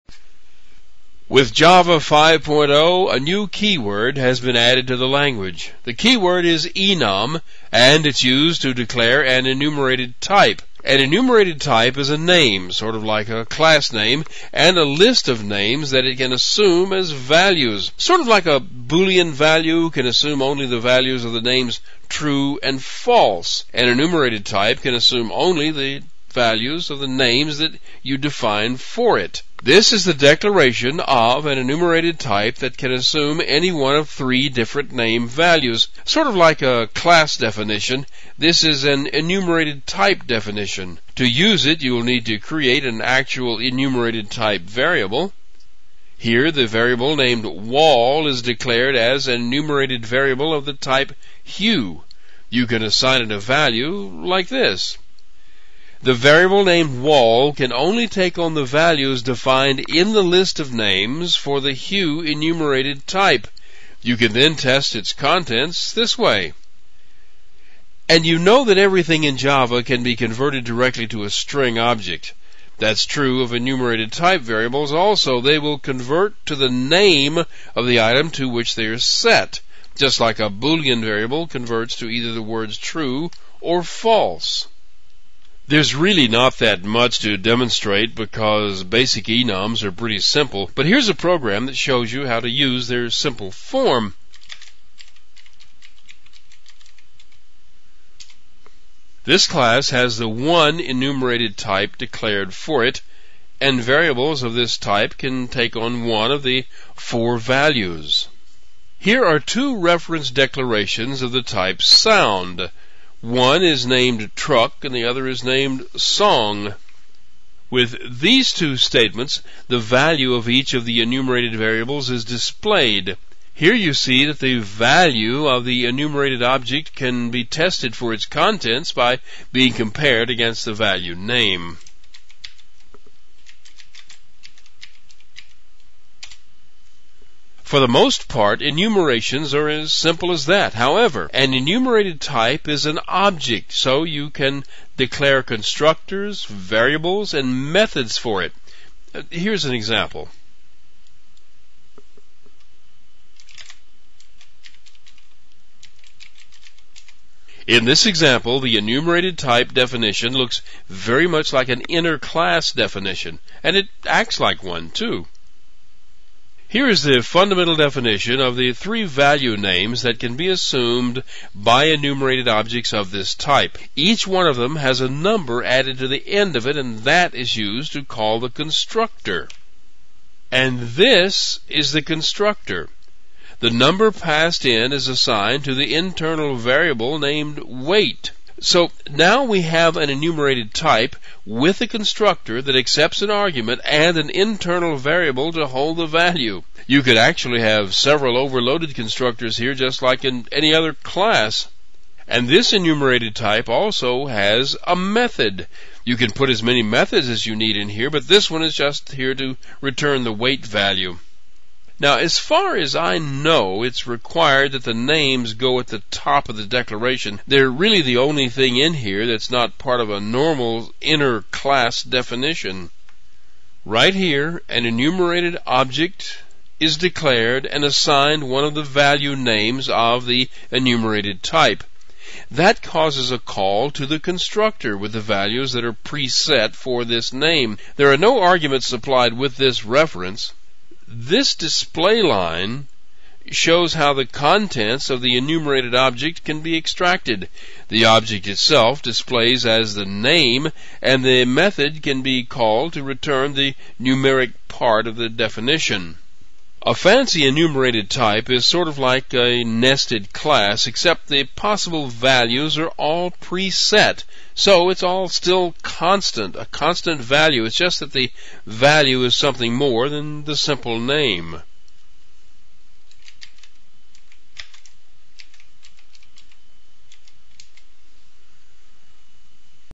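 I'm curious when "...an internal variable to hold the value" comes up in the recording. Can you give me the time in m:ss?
3:14.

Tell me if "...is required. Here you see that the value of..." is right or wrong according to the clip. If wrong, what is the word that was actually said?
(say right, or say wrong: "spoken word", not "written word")
wrong: "displayed", not "required".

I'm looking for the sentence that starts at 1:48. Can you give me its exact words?
Here are two reference declarations of the type sound.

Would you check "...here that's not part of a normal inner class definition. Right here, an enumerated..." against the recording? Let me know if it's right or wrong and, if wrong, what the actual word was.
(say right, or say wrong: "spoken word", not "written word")
right.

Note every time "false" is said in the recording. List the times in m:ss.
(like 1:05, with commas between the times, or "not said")
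0:22, 1:23.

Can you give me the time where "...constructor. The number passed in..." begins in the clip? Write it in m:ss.
3:02.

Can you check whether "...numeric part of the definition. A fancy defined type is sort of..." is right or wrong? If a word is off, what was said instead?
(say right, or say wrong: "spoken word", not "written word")
wrong: "enumerated", not "defined".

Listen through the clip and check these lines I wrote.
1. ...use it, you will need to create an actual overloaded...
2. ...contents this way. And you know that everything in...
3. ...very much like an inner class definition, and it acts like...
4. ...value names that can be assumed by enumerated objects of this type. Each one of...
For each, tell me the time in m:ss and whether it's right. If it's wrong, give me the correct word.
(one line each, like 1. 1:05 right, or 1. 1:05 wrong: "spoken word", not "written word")
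1. 0:41 wrong: "enumerated", not "overloaded"
2. 1:05 right
3. 2:40 right
4. 2:49 right.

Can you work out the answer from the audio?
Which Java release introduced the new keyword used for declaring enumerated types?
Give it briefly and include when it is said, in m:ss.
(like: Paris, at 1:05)
Java 5.0, at 0:01.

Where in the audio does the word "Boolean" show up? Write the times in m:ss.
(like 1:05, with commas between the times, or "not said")
0:18, 1:20.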